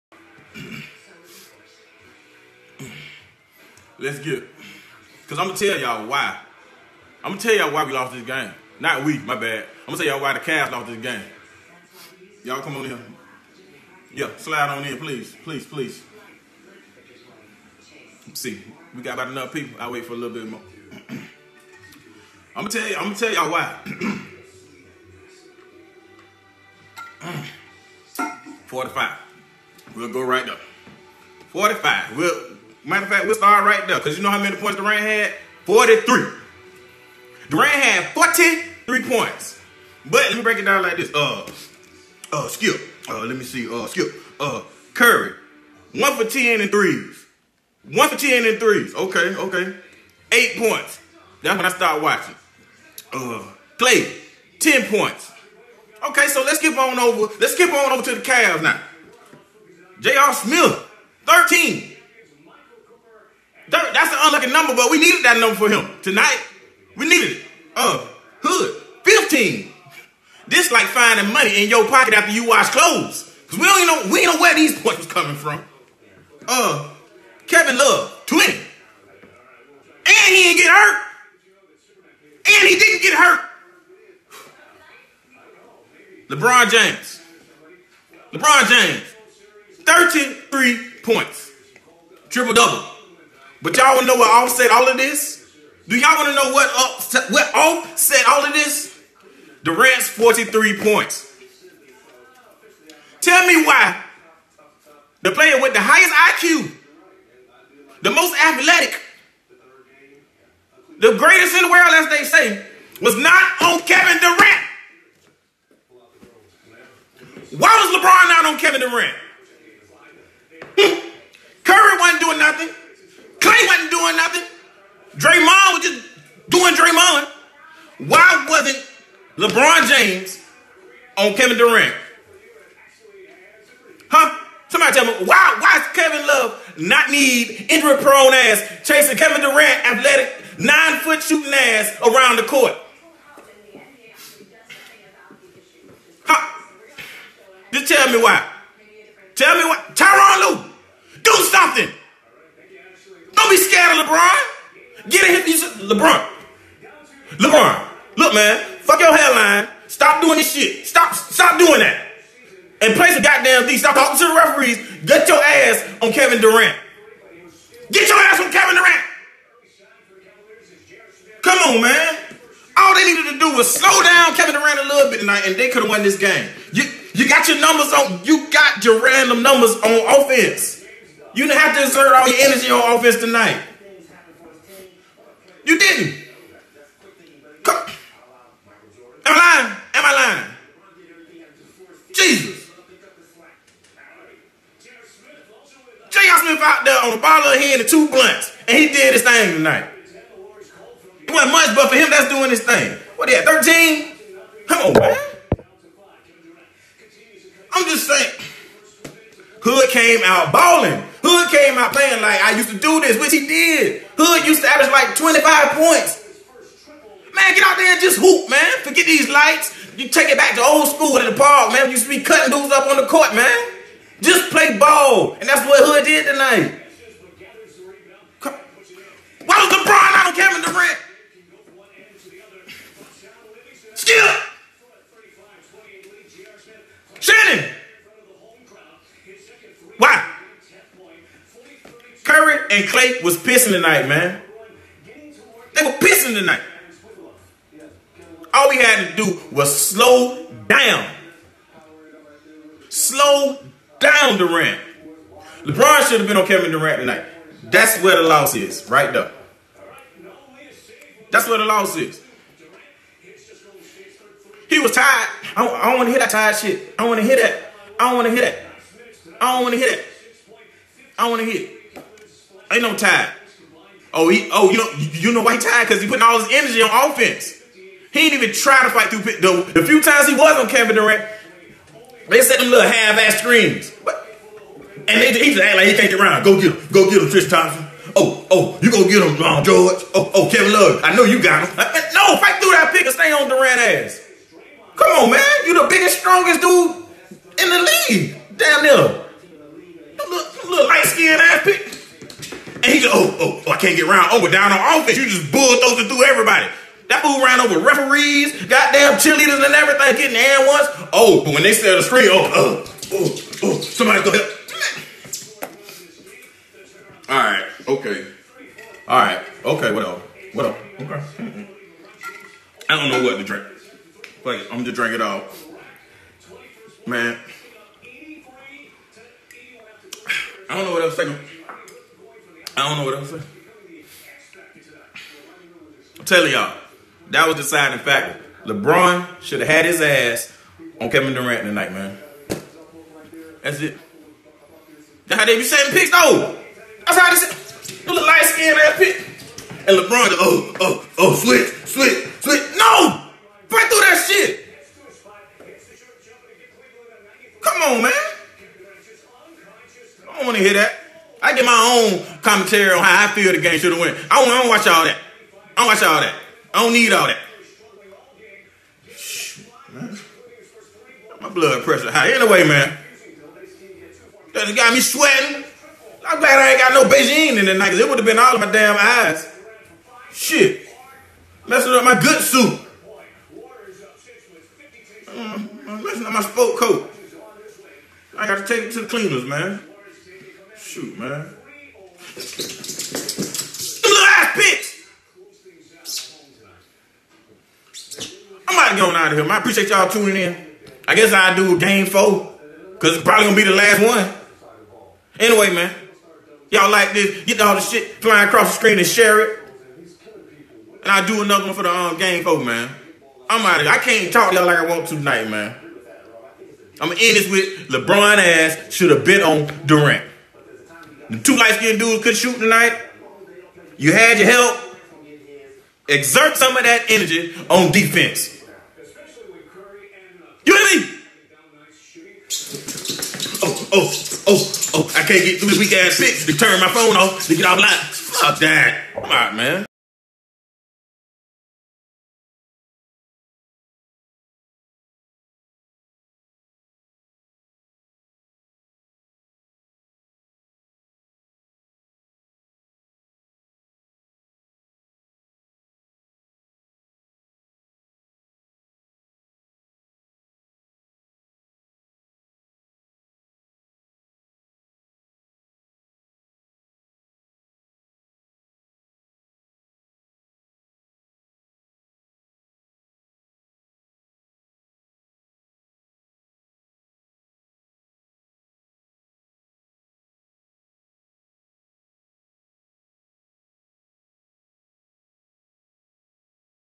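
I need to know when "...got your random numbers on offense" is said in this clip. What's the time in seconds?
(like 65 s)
178 s.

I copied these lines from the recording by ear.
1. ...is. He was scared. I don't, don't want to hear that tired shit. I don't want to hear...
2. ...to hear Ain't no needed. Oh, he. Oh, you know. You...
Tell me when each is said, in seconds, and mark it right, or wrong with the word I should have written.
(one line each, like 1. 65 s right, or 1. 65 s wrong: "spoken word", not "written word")
1. 261 s wrong: "tired", not "scared"
2. 271 s wrong: "tired", not "needed".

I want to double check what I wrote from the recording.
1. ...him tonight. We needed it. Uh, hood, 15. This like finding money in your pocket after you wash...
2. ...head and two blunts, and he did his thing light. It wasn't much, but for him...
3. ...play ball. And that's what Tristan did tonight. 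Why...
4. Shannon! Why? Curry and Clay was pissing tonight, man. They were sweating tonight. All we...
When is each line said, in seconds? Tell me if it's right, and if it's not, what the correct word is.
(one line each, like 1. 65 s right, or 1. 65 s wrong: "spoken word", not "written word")
1. 65 s right
2. 197 s wrong: "tonight", not "light"
3. 224 s wrong: "Hood", not "Tristan"
4. 237 s wrong: "pissing", not "sweating".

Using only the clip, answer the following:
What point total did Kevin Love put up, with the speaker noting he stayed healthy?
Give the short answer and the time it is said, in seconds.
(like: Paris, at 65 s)
20, at 78 s.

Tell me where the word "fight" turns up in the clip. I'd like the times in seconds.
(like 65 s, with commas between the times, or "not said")
278 s, 292 s.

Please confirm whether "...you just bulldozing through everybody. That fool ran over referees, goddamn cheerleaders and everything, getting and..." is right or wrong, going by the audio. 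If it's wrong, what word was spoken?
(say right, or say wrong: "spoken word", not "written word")
right.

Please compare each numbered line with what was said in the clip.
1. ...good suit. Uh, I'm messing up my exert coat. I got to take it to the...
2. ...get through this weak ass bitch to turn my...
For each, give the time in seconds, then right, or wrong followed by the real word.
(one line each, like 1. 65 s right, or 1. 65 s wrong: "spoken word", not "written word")
1. 382 s wrong: "sport", not "exert"
2. 435 s right.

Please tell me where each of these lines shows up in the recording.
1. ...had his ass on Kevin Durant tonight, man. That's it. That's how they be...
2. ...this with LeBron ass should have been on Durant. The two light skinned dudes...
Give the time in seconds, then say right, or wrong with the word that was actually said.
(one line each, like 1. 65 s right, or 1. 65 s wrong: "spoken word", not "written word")
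1. 339 s right
2. 417 s right.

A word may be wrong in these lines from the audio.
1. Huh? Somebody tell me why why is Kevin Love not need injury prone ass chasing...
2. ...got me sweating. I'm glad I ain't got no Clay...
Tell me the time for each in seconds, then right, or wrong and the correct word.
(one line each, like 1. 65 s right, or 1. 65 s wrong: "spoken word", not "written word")
1. 134 s right
2. 374 s wrong: "Beijing", not "Clay".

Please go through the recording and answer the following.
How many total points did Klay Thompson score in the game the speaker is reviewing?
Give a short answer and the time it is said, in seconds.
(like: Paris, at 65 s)
10, at 54 s.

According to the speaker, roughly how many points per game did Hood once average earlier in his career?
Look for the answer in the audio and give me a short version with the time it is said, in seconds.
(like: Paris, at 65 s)
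25, at 215 s.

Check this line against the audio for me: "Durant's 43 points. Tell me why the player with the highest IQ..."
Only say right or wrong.
right.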